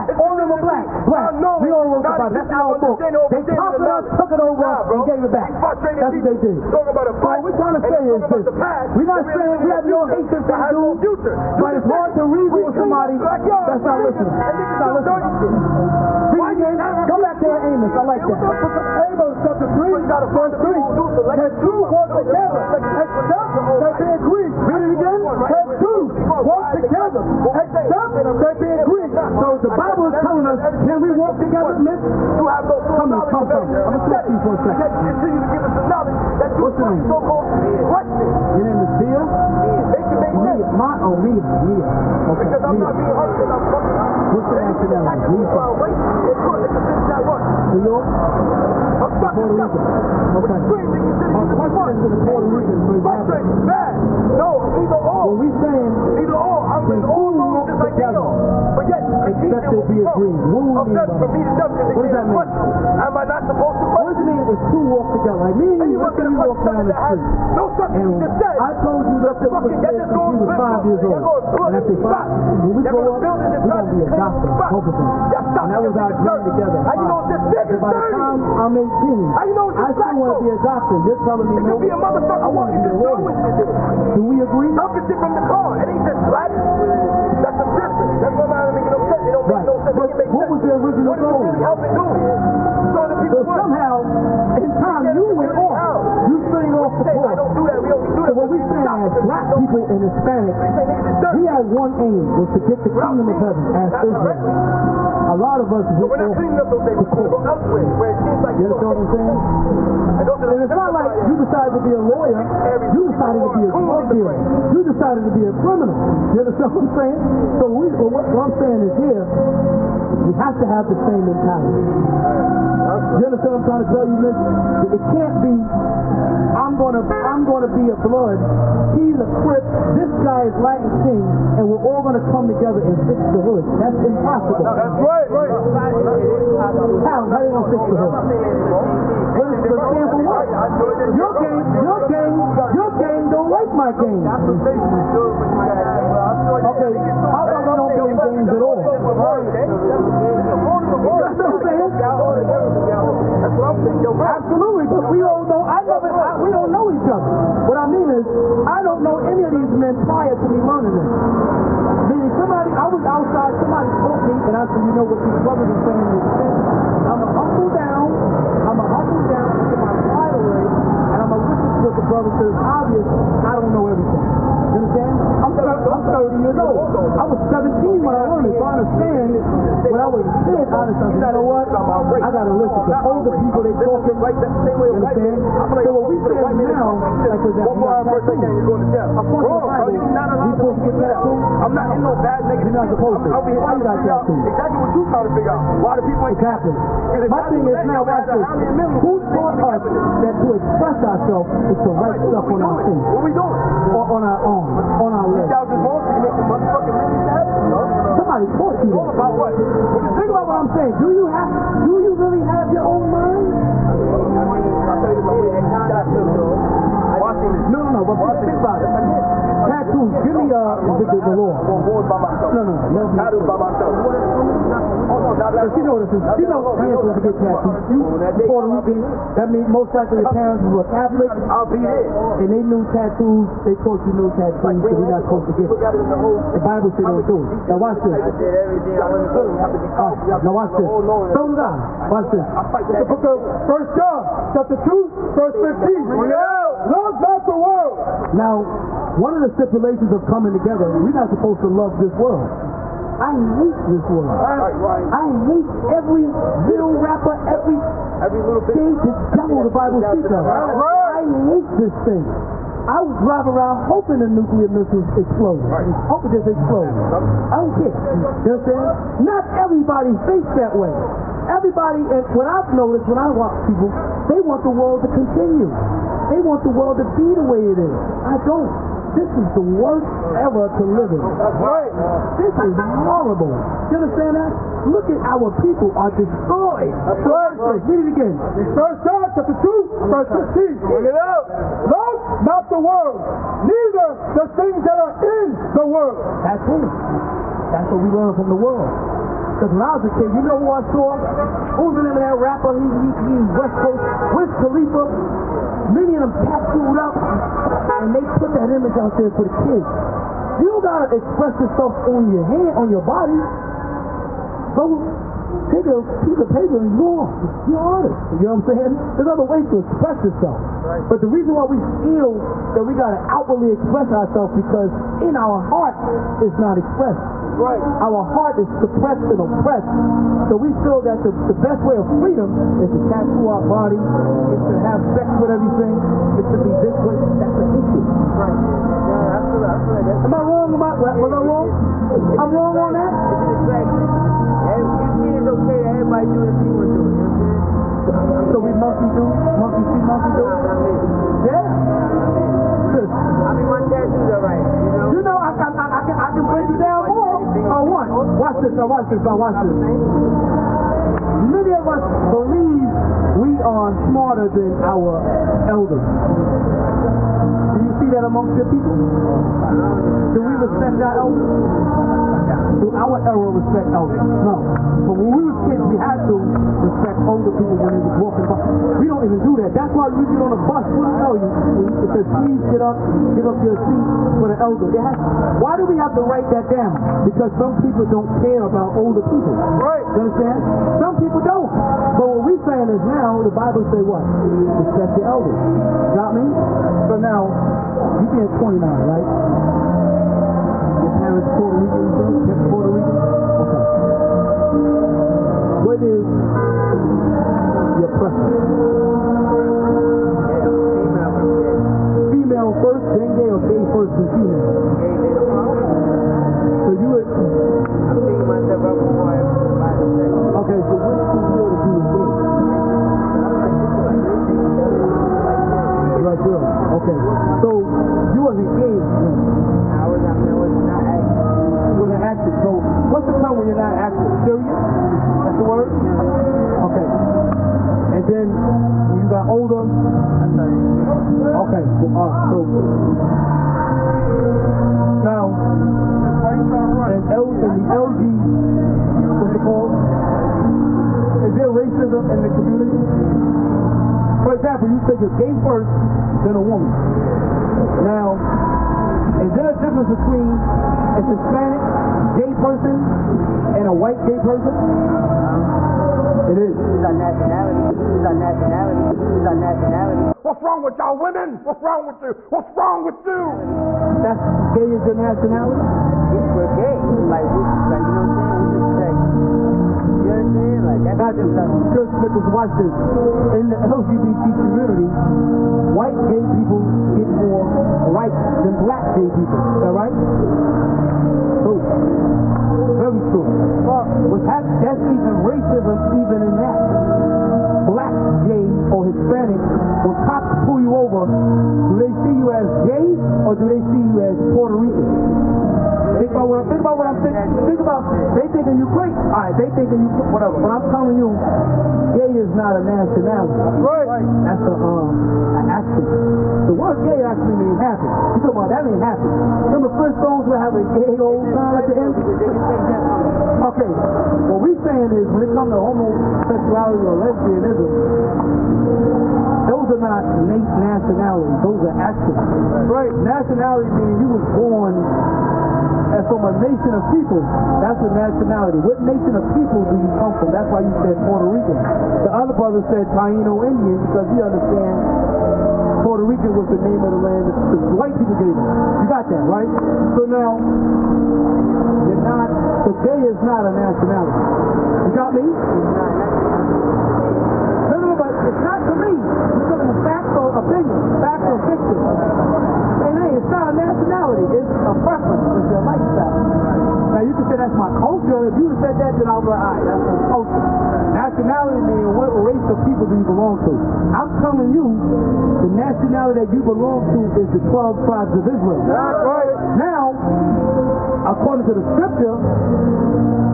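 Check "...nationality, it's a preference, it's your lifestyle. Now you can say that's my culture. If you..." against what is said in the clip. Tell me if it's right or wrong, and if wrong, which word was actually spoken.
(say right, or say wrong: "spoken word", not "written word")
right.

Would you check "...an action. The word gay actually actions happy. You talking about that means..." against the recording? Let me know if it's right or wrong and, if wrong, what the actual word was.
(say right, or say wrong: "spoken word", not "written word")
wrong: "means", not "actions".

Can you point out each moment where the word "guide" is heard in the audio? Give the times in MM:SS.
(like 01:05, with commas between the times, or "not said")
not said.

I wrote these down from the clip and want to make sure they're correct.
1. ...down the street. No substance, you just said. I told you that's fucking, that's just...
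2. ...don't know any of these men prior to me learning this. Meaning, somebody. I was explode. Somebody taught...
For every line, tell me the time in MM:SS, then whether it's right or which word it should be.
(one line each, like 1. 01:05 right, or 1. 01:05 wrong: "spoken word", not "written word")
1. 01:06 right
2. 02:38 wrong: "outside", not "explode".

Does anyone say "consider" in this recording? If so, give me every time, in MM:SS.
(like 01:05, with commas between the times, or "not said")
00:46, 00:50.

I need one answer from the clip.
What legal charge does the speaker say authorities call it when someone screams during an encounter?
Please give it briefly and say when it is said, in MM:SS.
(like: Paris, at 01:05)
Obstructive justice, at 00:49.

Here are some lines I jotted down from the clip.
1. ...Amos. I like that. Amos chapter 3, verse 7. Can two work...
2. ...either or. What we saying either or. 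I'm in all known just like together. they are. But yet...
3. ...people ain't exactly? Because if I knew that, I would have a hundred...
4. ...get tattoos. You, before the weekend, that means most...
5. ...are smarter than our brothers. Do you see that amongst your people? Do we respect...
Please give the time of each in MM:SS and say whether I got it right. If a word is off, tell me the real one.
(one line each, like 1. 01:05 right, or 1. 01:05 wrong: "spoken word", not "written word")
1. 00:17 wrong: "3", not "7"
2. 00:54 right
3. 03:16 right
4. 03:47 right
5. 06:03 wrong: "elders", not "brothers".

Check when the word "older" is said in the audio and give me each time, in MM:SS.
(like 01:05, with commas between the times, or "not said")
03:03, 06:17, 06:28, 07:19.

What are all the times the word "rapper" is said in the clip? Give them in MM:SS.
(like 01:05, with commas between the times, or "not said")
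04:17, 05:02.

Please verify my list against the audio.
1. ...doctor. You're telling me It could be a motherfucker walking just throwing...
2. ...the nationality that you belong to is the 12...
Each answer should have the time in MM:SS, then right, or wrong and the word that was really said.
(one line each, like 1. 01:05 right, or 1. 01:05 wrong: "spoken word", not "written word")
1. 01:20 right
2. 09:35 right.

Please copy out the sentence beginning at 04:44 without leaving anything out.
Look at our people are destroyed.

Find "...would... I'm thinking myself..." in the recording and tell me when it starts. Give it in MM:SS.
06:57.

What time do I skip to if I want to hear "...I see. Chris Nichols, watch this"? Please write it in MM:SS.
08:01.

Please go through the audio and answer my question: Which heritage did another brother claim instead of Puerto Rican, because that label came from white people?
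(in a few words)
Taino Indian.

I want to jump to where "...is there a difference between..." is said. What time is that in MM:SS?
07:39.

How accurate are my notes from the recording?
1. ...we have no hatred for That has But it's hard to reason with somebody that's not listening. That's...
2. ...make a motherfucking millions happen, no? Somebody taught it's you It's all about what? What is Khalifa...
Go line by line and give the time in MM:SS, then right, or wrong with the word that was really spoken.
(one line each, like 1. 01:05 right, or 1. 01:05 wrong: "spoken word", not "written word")
1. 00:09 right
2. 03:26 wrong: "Think", not "Khalifa".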